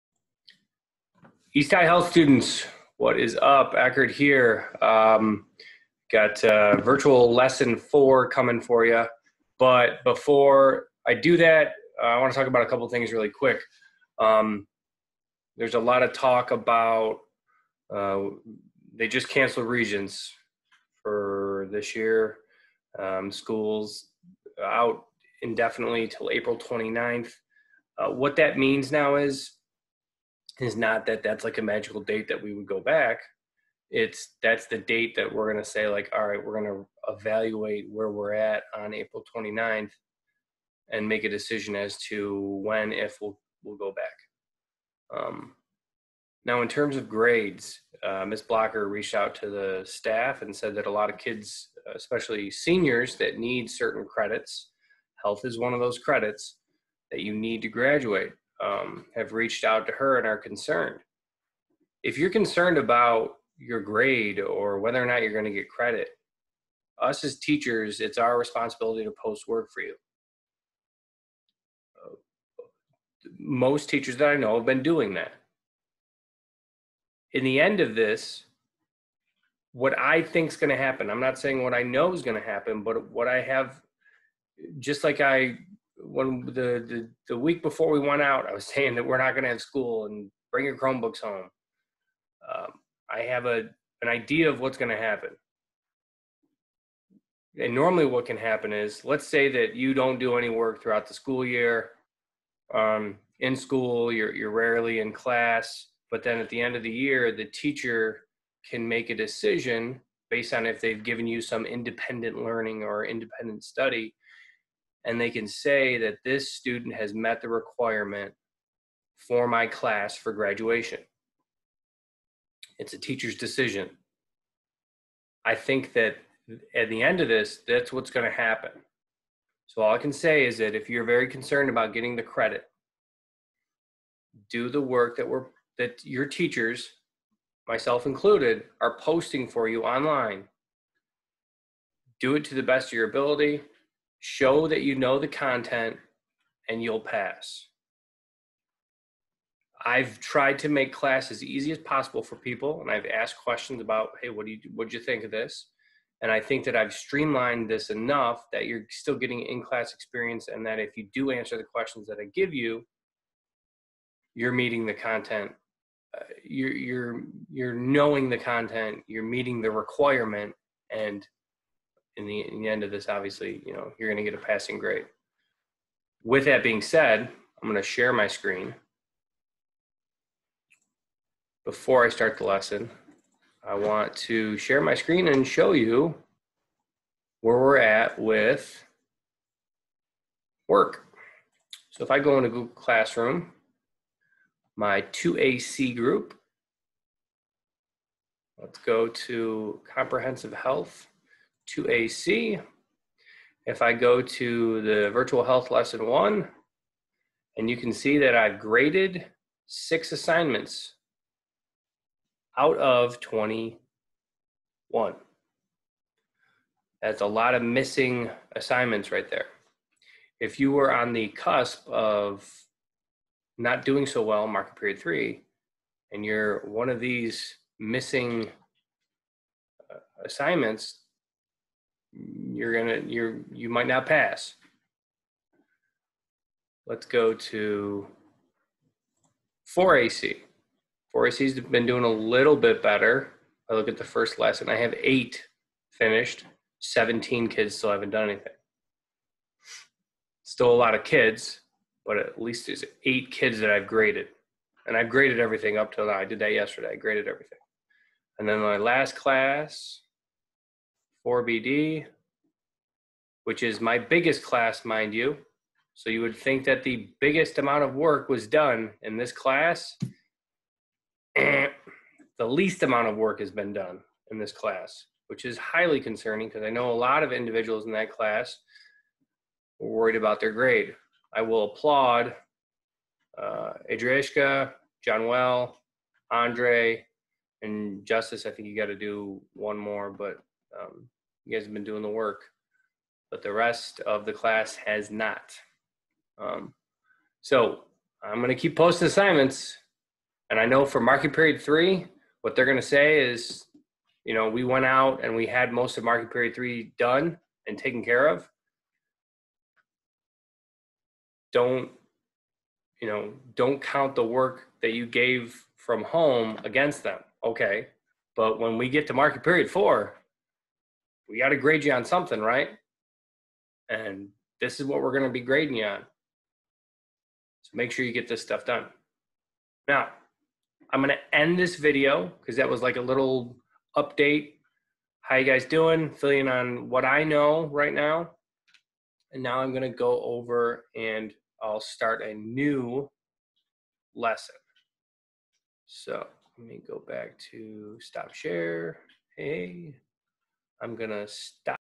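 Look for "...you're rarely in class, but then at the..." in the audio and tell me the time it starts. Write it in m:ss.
1:44.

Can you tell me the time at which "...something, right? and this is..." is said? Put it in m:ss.
5:22.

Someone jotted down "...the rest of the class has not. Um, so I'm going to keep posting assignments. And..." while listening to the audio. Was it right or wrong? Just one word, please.
right.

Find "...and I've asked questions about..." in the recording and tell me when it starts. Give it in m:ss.
2:32.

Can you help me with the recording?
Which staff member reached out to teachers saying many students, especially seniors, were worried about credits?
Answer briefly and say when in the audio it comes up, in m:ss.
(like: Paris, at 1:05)
Ms. Blocker, at 0:48.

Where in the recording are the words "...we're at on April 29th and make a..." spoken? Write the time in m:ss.
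0:38.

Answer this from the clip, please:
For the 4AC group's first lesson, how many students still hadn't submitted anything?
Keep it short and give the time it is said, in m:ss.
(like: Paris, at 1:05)
17, at 4:06.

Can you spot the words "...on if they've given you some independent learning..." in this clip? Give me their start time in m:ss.
1:50.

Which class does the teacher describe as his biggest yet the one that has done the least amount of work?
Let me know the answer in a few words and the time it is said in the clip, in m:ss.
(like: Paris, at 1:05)
4BD, at 4:21.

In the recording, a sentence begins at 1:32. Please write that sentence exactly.
Um, I have a an idea of what's going to happen.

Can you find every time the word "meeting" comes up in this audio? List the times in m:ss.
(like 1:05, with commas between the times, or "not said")
2:44, 2:49.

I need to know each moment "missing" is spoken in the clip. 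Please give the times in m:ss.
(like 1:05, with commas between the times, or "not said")
3:37, 3:47.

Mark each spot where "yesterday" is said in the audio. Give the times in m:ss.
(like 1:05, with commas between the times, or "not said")
4:16.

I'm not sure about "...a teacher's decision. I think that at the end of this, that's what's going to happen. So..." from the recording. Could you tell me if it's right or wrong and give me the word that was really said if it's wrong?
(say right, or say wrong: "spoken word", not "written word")
right.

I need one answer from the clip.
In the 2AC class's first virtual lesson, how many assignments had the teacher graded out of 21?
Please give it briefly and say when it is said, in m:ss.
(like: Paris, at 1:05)
6, at 3:29.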